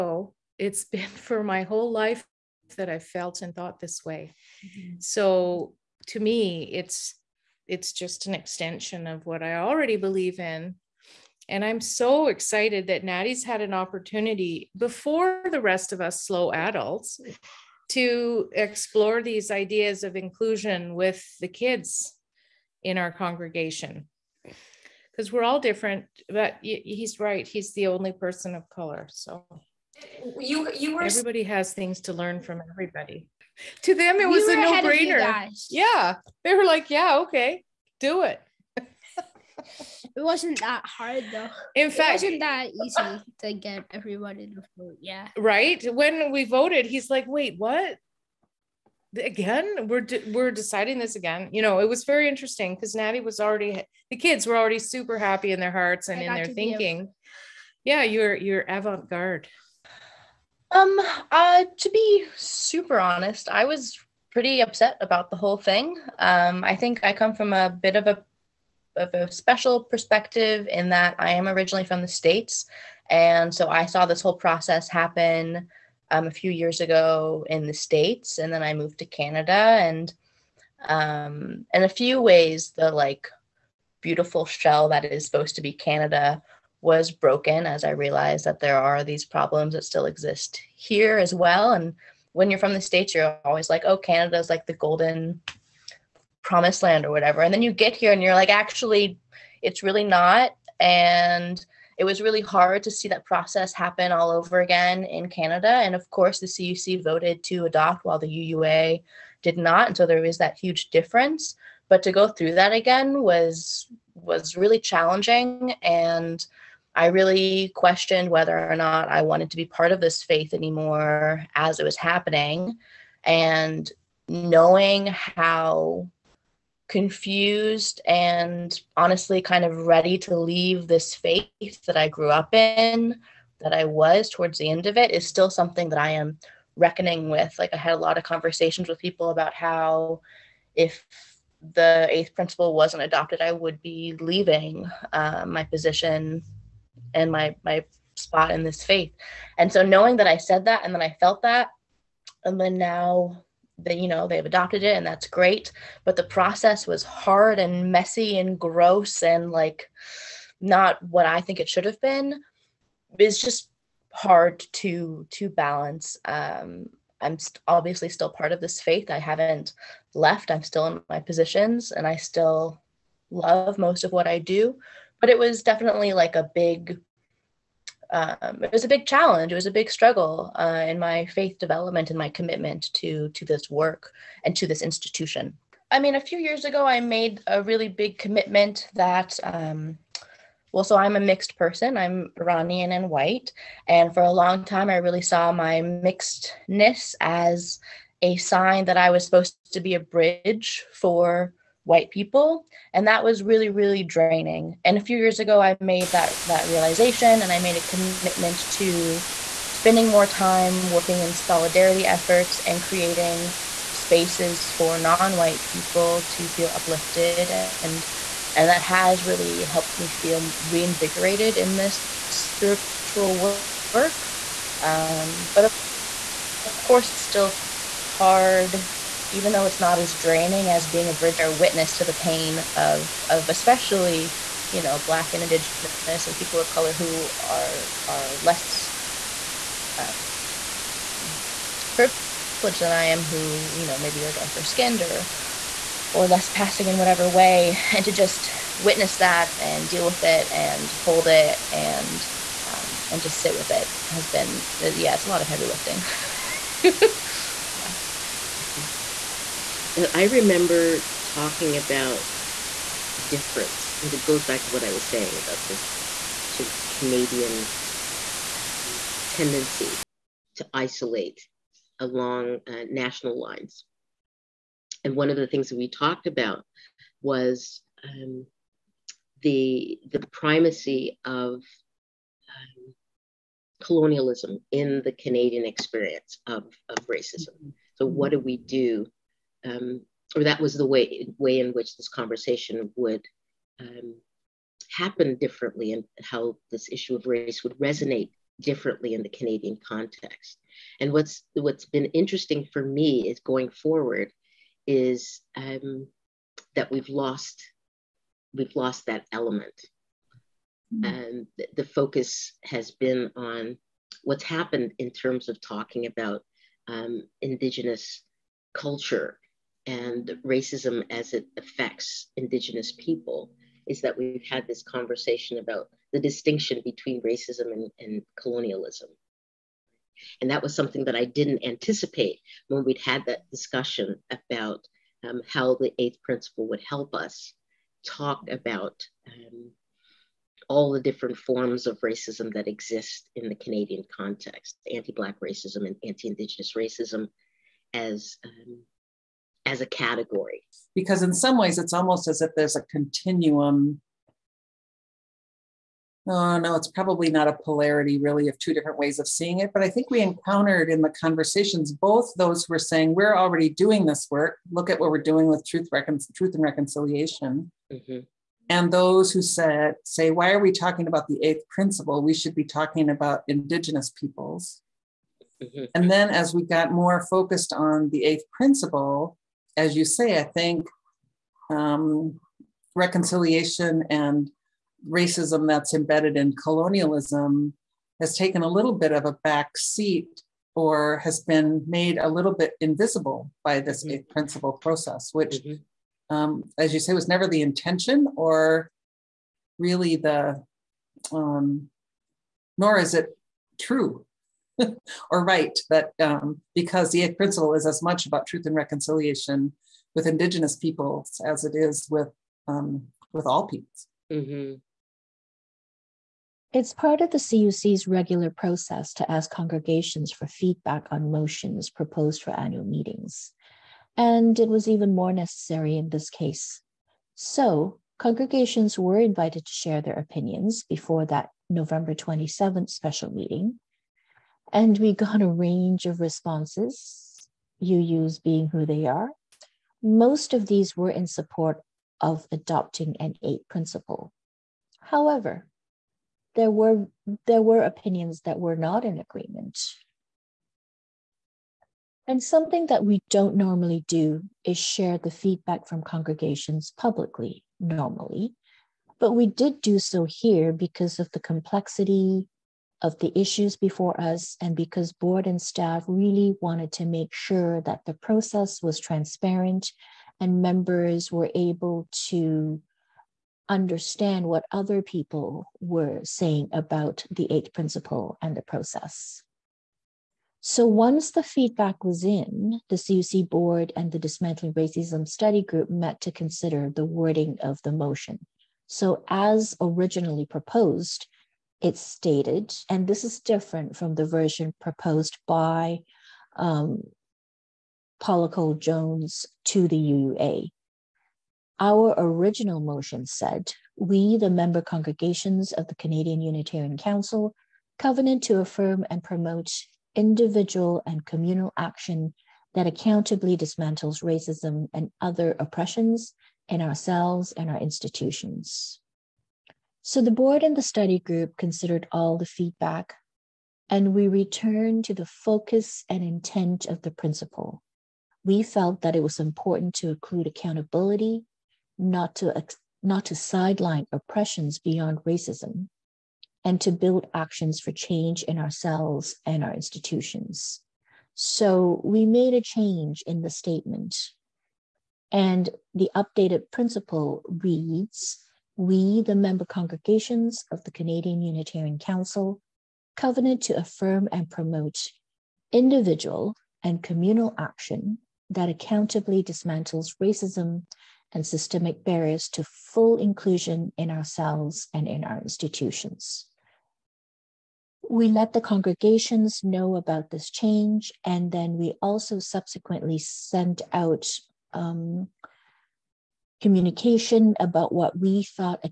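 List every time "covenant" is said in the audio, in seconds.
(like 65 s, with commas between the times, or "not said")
507 s, 553 s.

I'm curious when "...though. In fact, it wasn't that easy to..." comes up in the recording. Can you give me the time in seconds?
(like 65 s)
41 s.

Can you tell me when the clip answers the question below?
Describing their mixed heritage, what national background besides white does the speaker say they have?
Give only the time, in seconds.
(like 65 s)
192 s.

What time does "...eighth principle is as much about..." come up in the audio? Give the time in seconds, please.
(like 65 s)
407 s.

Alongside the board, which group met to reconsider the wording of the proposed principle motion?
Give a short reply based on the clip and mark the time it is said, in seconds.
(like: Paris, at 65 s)
Dismantling Racism Study Group, at 484 s.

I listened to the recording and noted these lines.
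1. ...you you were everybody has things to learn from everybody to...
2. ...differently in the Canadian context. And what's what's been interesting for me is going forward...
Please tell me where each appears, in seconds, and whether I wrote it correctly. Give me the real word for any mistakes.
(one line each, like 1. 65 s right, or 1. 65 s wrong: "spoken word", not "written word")
1. 30 s right
2. 298 s right.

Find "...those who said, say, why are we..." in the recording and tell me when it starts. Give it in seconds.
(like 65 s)
368 s.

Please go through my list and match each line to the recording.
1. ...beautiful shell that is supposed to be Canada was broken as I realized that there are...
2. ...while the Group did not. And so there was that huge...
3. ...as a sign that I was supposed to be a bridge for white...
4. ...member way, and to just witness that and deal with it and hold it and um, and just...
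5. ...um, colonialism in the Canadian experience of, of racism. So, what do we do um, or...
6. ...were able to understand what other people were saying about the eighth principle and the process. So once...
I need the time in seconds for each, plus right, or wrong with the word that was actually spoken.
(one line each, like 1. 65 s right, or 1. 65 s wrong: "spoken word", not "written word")
1. 84 s right
2. 108 s wrong: "UUA", not "Group"
3. 197 s right
4. 246 s wrong: "whatever", not "member"
5. 281 s right
6. 471 s right.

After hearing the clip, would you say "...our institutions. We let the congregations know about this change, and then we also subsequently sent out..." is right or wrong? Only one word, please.
right.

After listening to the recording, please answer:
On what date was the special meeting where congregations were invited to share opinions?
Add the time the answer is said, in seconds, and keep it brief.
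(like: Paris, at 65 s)
November 27, at 431 s.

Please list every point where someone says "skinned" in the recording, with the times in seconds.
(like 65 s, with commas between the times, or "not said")
244 s.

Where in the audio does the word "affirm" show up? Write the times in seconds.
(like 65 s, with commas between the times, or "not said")
508 s, 553 s.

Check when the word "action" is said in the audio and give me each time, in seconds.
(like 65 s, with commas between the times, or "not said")
511 s, 537 s, 557 s.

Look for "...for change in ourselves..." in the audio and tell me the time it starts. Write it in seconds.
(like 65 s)
537 s.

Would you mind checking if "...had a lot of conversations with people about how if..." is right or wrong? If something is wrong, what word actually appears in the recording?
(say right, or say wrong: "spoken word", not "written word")
right.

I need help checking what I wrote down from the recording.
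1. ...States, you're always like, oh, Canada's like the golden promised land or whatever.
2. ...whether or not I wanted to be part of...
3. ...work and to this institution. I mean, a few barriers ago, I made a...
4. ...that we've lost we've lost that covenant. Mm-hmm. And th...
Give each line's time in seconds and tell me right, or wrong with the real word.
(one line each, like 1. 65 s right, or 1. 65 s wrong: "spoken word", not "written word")
1. 92 s right
2. 118 s right
3. 183 s wrong: "years", not "barriers"
4. 306 s wrong: "element", not "covenant".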